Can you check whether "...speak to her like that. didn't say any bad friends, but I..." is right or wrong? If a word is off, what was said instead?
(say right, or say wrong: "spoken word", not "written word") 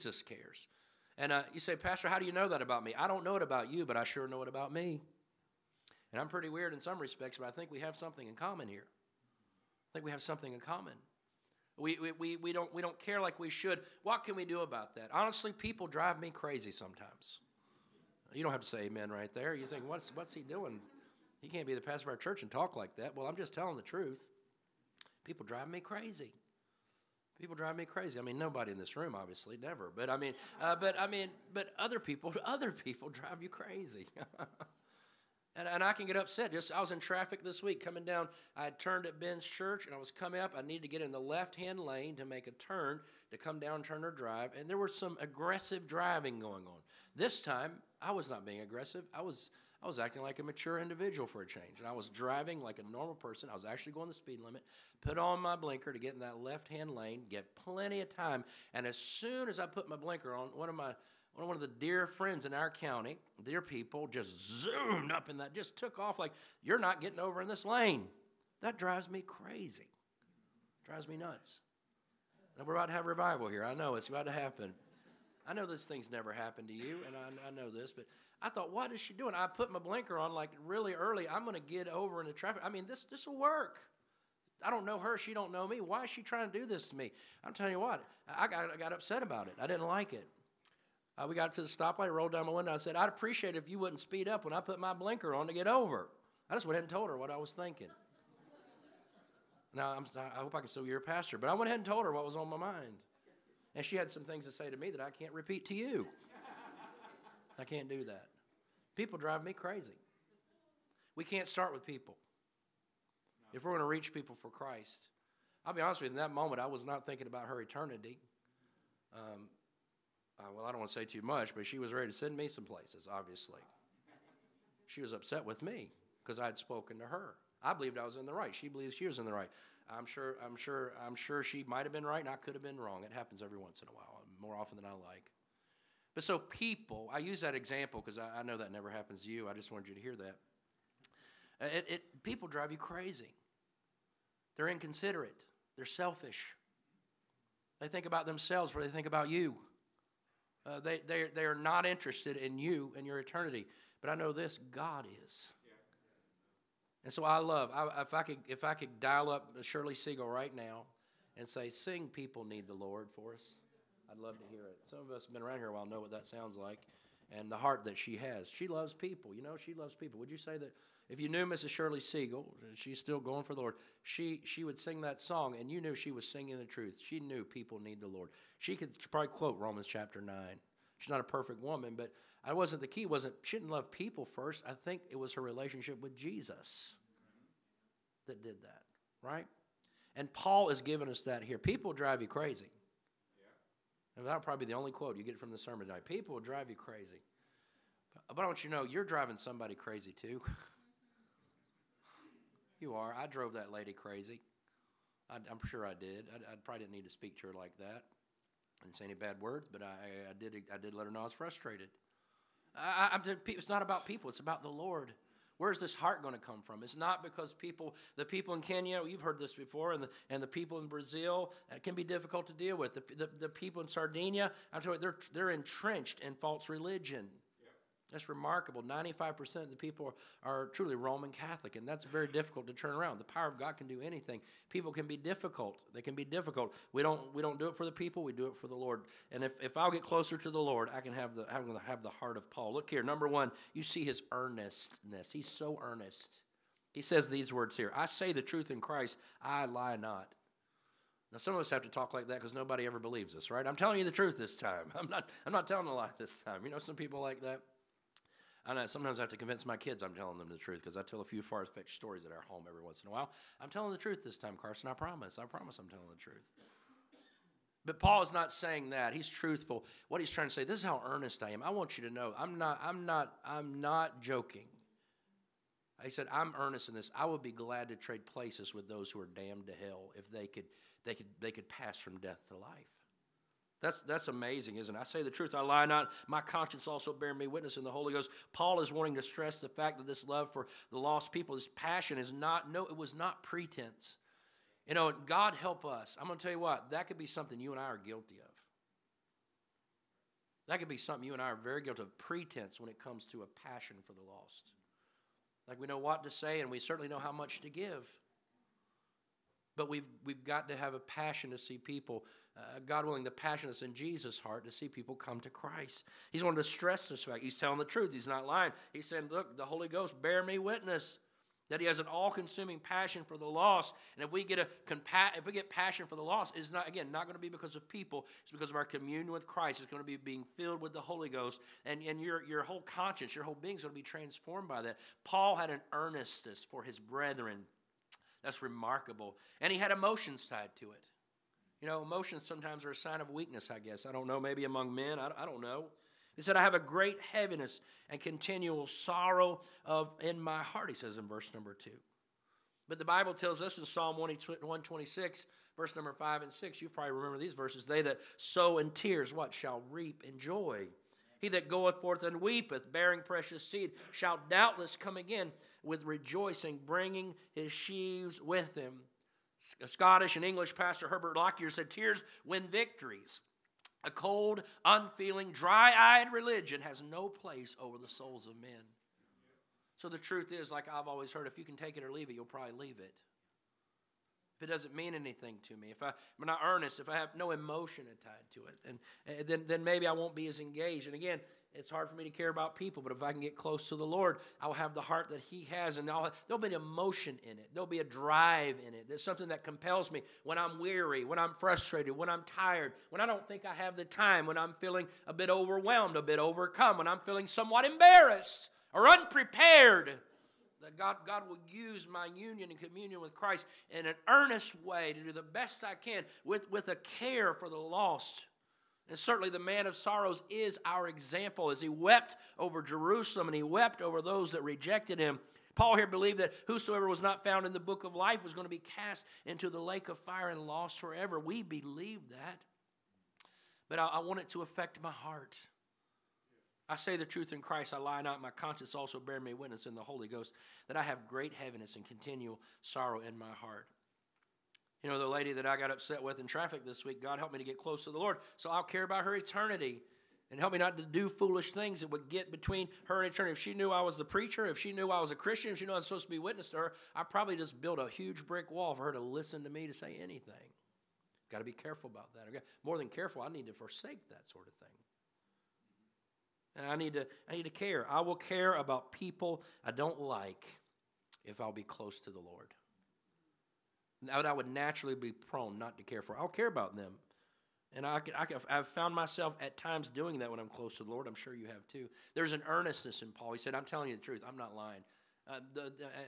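wrong: "words", not "friends".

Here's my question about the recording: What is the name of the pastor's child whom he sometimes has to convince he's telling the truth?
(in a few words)
Carson.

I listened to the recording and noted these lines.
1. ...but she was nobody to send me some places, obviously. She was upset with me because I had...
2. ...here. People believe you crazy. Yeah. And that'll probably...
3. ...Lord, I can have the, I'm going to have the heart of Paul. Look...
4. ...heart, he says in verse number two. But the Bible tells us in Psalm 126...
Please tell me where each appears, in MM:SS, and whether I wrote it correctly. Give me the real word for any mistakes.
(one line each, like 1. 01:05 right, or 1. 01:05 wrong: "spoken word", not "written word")
1. 02:01 wrong: "ready", not "nobody"
2. 03:11 wrong: "drive", not "believe"
3. 04:00 right
4. 05:50 right.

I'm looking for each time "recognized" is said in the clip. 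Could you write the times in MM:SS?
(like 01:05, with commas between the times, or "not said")
not said.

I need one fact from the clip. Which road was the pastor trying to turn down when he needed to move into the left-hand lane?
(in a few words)
Turner Drive.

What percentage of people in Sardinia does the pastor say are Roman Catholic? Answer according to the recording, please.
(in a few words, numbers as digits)
95%.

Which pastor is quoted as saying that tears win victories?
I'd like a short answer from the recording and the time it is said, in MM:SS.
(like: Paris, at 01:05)
Herbert Lockyer, at 06:11.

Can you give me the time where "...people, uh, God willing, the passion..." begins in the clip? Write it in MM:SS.
05:11.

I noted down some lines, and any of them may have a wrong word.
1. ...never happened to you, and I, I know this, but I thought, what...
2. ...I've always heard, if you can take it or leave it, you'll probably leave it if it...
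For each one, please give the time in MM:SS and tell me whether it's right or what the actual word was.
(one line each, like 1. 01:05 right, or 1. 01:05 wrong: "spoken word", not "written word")
1. 01:16 right
2. 06:20 right.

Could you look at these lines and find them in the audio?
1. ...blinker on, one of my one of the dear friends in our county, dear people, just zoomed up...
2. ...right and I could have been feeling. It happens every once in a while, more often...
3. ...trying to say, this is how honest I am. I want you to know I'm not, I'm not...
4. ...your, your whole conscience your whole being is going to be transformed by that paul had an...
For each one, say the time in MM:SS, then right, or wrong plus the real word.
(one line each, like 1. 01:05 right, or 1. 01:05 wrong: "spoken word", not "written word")
1. 00:59 right
2. 02:12 wrong: "wrong", not "feeling"
3. 04:30 wrong: "earnest", not "honest"
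4. 05:32 right.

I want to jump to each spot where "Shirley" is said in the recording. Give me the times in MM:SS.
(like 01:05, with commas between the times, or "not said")
02:39, 02:51.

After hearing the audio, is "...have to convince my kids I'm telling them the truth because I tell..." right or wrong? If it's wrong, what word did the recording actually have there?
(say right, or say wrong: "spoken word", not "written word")
right.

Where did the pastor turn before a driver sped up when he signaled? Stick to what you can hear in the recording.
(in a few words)
Benns Church.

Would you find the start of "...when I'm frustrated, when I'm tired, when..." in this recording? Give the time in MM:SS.
06:41.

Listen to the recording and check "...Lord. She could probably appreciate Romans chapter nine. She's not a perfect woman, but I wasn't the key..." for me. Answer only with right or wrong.
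wrong.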